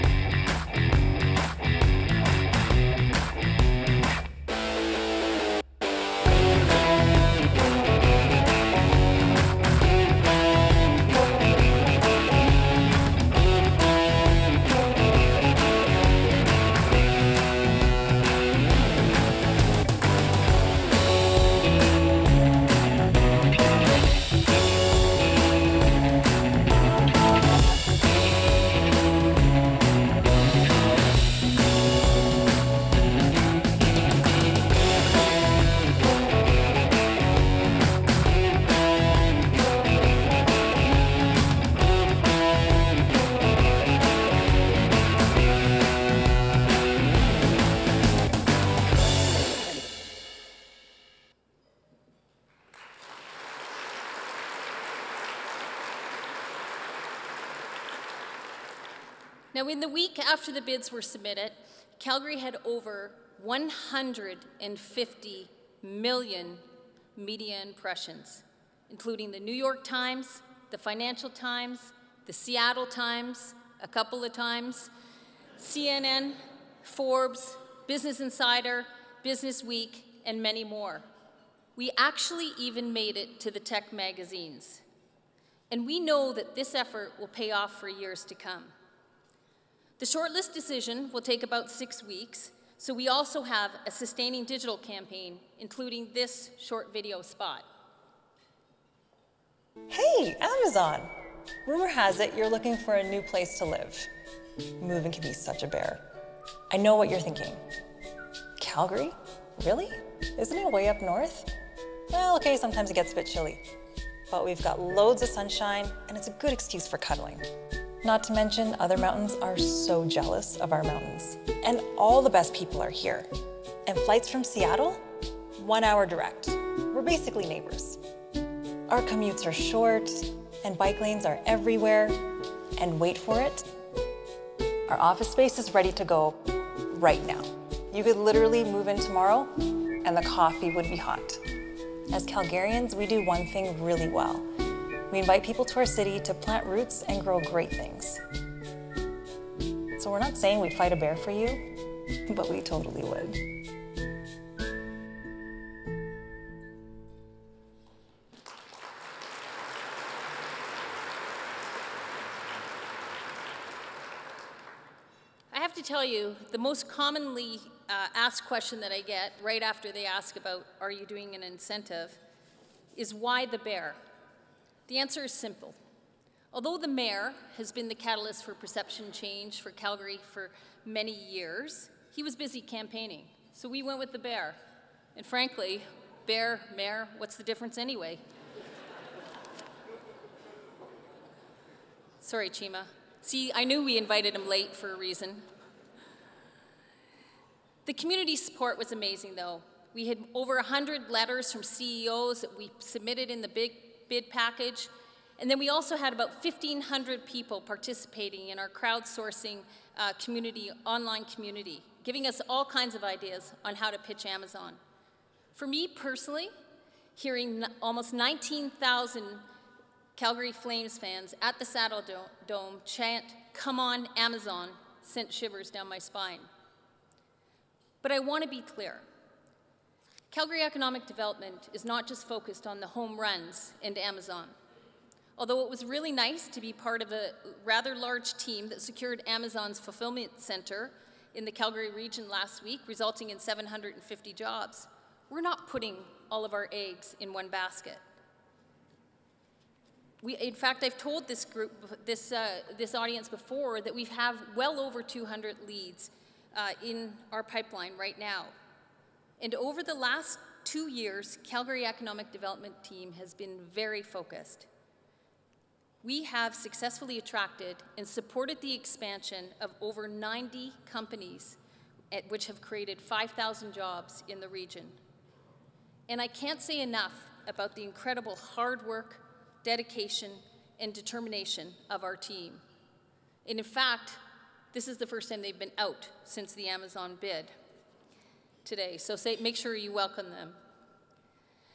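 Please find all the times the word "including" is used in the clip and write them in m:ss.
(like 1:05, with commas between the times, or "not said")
1:08, 1:35.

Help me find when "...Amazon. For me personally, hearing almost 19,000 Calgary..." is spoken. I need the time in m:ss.
3:34.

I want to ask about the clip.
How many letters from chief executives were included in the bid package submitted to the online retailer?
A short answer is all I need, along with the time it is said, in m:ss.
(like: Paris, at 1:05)
Over 100, at 3:20.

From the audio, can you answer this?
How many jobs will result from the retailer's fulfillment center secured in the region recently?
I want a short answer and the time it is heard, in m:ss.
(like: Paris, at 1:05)
750, at 4:03.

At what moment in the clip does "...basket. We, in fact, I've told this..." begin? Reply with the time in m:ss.
4:07.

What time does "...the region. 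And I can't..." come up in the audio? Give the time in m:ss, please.
4:34.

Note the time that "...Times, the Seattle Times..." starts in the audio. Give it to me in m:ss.
1:11.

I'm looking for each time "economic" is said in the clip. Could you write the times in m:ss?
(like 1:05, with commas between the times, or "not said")
3:50, 4:21.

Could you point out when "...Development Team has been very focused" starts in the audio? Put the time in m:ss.
4:22.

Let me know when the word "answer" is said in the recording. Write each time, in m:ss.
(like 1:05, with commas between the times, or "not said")
2:54.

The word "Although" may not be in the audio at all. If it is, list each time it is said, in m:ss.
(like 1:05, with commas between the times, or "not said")
2:56, 3:55.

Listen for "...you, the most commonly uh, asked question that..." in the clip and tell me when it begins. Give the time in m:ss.
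2:46.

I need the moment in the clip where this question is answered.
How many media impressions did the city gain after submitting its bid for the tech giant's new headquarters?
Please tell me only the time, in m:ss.
1:02.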